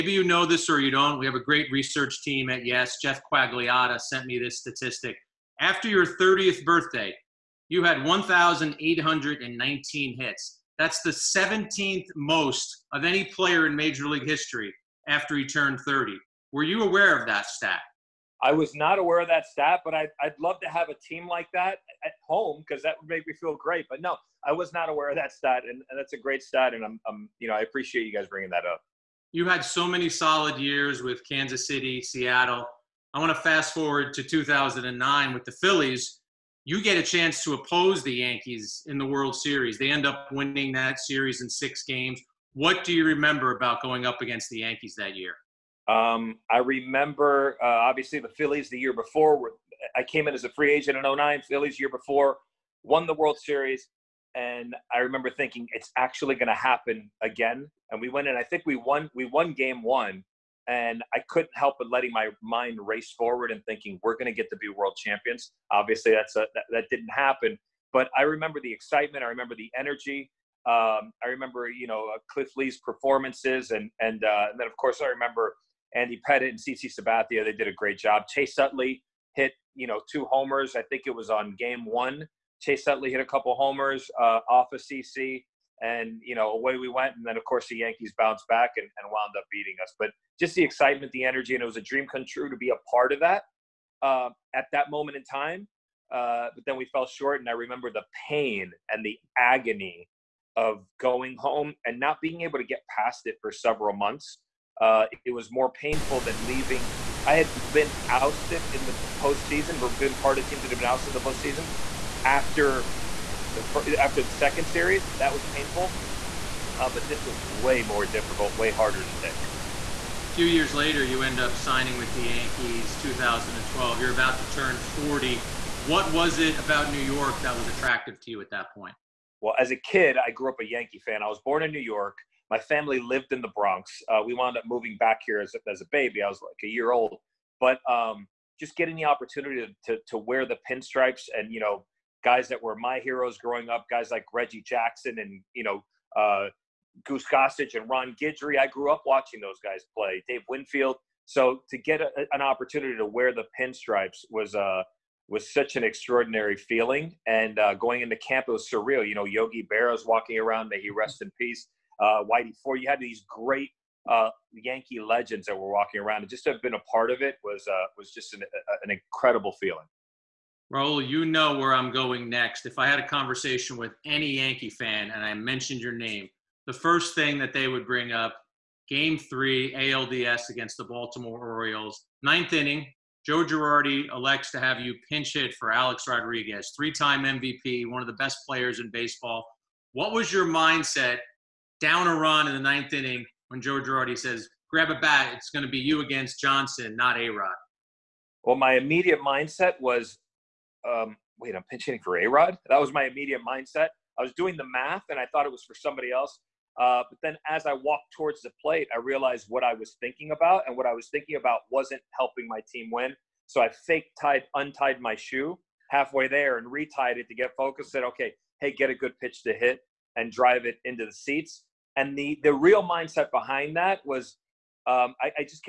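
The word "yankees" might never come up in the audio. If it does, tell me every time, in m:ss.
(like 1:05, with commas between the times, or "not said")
0:38, 0:44, 1:27, 2:02, 2:10, 2:44, 2:54.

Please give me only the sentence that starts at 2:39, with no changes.
You know, Yogi Berra's walking around, may he rest in peace.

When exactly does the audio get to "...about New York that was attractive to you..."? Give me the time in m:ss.
2:06.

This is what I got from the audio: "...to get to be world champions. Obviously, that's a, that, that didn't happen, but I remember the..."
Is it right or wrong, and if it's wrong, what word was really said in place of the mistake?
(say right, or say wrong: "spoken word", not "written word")
right.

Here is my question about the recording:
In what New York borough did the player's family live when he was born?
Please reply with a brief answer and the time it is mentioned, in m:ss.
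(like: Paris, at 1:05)
the Bronx, at 2:13.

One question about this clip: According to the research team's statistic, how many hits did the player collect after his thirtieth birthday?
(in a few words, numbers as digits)
1,819.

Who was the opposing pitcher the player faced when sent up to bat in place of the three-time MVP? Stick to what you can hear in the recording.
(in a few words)
Johnson.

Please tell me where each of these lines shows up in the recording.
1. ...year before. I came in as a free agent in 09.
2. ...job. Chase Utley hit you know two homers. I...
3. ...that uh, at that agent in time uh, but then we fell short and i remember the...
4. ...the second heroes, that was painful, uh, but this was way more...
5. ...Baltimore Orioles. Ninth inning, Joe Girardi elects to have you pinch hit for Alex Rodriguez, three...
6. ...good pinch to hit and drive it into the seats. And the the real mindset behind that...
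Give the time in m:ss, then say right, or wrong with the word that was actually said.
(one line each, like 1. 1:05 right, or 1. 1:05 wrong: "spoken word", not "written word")
1. 0:48 right
2. 1:17 right
3. 1:33 wrong: "moment", not "agent"
4. 1:54 wrong: "series", not "heroes"
5. 3:00 right
6. 3:38 wrong: "pitch", not "pinch".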